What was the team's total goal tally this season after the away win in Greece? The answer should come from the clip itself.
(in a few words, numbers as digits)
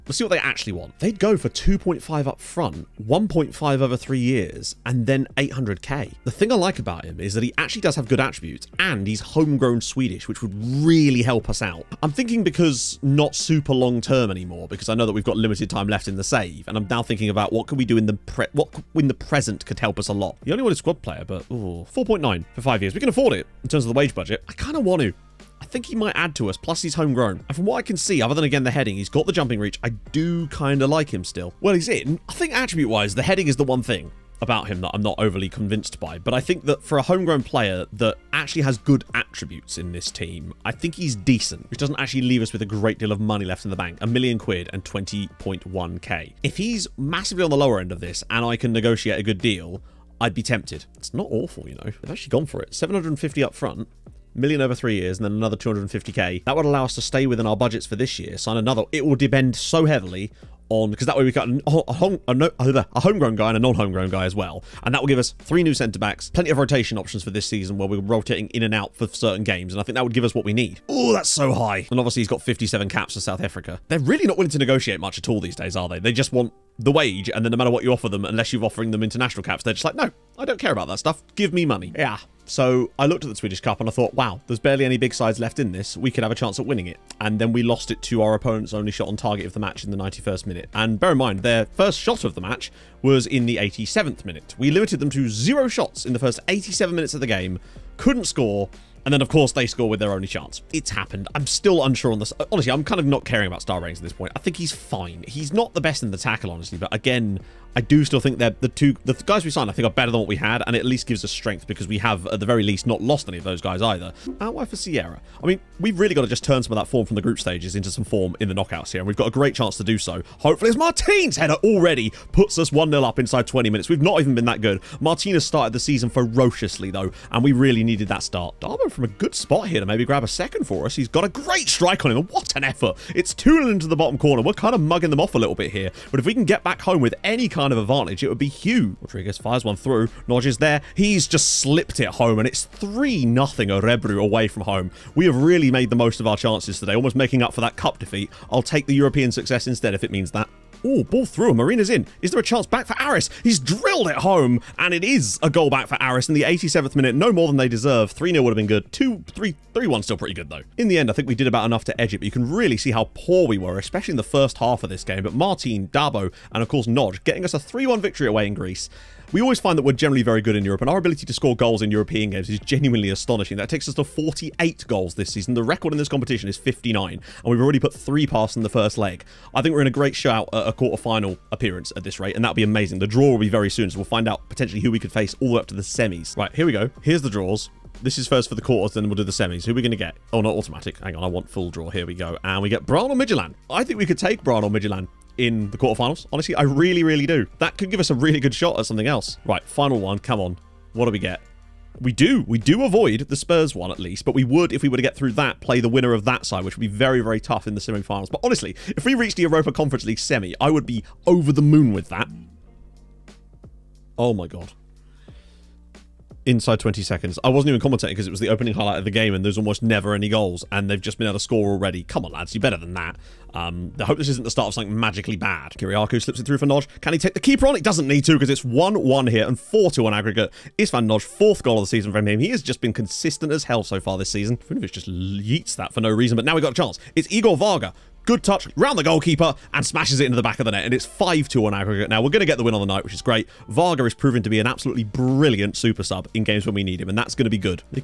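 48.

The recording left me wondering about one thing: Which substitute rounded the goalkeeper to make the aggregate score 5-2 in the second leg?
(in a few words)
Igor Varga.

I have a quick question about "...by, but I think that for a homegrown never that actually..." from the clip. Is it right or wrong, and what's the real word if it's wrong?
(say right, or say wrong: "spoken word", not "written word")
wrong: "player", not "never".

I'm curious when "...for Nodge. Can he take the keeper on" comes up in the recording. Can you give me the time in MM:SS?
03:46.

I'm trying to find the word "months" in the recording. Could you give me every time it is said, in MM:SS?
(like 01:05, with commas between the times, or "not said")
not said.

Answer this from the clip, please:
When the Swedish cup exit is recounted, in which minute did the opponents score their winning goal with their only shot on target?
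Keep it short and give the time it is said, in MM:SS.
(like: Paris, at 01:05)
91st minute, at 01:29.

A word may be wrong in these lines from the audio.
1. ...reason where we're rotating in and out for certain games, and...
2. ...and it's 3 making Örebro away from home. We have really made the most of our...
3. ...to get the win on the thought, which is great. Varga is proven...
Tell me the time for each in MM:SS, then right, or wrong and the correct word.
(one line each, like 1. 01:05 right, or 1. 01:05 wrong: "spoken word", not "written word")
1. 01:07 wrong: "season", not "reason"
2. 02:22 wrong: "nothing", not "making"
3. 04:02 wrong: "night", not "thought".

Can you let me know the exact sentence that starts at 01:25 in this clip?
We could have a chance at winning it.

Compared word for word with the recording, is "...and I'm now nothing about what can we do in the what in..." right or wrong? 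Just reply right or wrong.
wrong.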